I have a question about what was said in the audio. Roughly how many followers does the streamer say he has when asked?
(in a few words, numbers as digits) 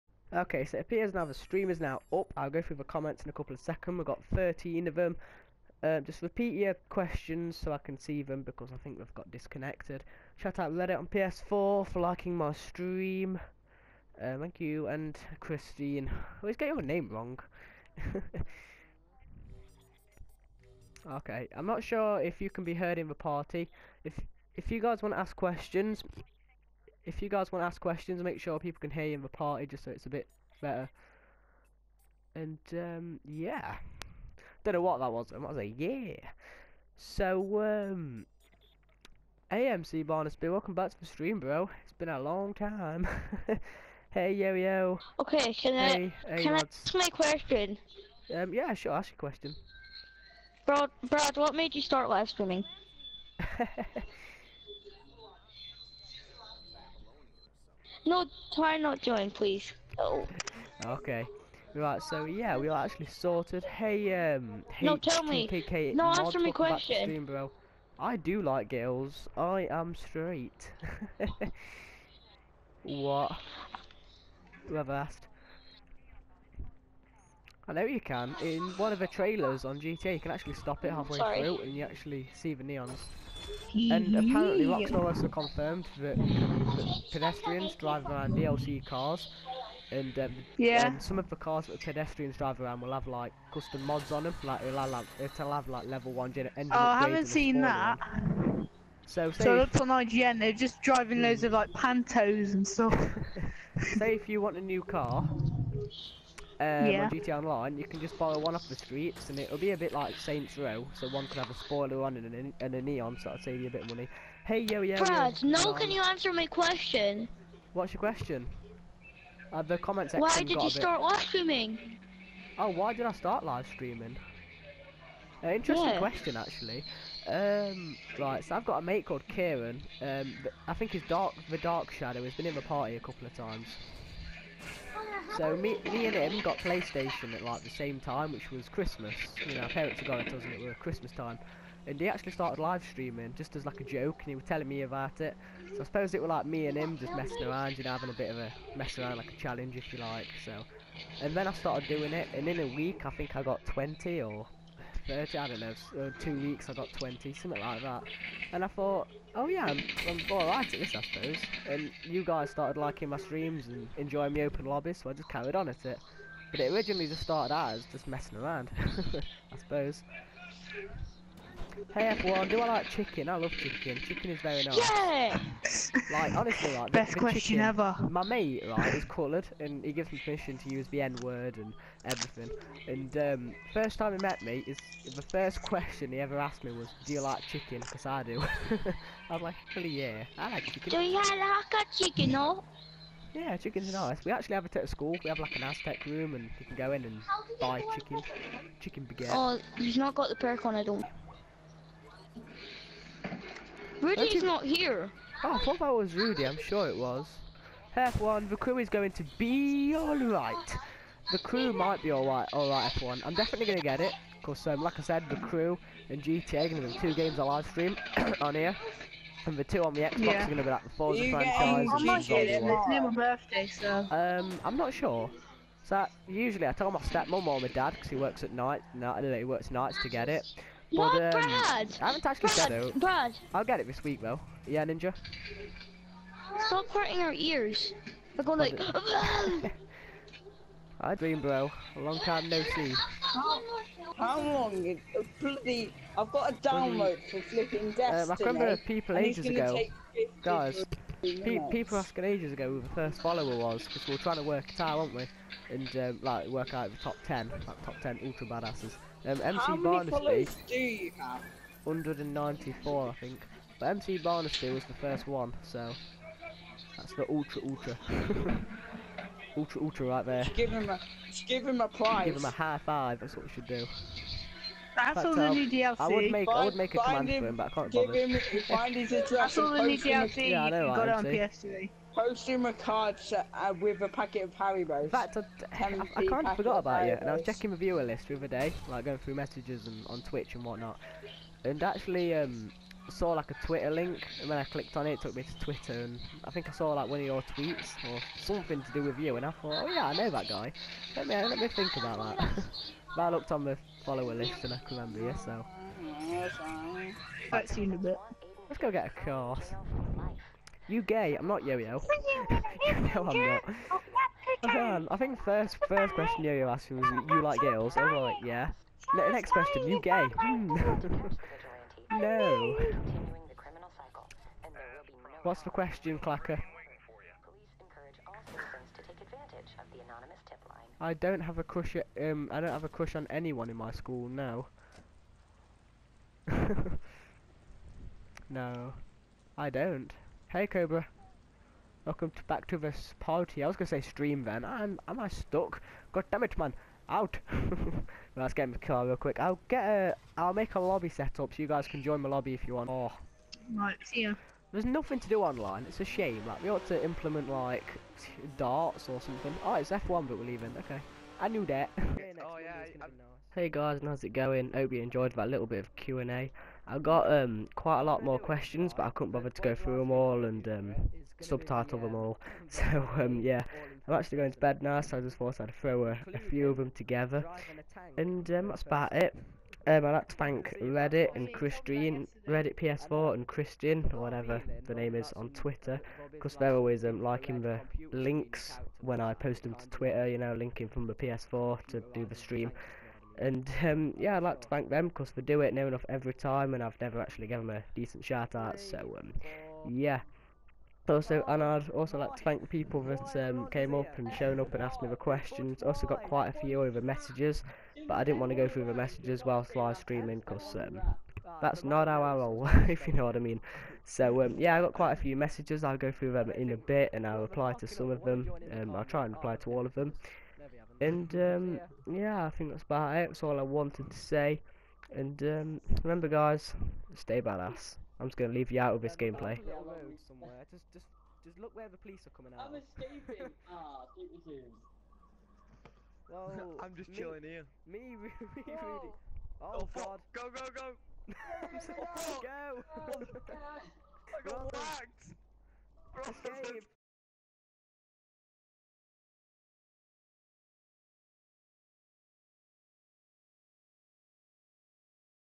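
194.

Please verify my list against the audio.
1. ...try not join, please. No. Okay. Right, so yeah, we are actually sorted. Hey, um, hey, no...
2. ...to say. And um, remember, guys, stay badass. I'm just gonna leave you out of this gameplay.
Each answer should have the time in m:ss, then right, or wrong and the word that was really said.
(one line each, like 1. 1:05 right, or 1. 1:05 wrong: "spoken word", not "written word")
1. 0:58 right
2. 7:04 right.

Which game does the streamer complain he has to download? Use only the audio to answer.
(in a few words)
Destiny.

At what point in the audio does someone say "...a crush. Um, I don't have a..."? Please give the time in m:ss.
5:31.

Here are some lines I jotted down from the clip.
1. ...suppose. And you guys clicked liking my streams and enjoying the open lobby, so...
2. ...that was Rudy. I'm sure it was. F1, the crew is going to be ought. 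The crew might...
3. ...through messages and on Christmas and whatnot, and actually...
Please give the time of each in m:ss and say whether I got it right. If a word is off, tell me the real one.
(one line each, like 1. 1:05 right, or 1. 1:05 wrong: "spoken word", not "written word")
1. 2:41 wrong: "started", not "clicked"
2. 3:25 wrong: "alright", not "ought"
3. 4:49 wrong: "Twitch", not "Christmas".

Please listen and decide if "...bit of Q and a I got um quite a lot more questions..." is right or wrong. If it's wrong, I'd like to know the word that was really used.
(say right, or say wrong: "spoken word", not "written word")
right.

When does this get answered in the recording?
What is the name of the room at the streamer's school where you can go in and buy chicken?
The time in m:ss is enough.
3:15.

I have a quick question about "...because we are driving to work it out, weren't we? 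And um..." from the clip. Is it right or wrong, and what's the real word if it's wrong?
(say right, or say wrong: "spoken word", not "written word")
wrong: "trying", not "driving".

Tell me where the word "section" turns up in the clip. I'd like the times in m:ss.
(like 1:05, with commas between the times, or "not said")
2:00.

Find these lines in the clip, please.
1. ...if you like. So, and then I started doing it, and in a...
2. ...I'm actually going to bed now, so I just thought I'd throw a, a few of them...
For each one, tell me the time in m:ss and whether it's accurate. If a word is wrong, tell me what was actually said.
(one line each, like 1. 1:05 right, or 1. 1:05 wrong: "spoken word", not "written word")
1. 2:29 right
2. 6:14 right.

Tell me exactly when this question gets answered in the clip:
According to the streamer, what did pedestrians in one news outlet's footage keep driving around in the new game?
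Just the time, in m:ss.
1:41.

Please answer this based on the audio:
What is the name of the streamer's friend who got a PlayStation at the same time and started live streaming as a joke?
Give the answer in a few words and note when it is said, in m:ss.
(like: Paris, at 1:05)
Kieran, at 2:09.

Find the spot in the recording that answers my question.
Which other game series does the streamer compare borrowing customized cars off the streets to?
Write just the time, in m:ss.
1:50.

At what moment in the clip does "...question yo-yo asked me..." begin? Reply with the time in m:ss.
5:16.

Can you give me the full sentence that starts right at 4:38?
Him, find his address That's all the new DLC yeah, I know, got on PS3.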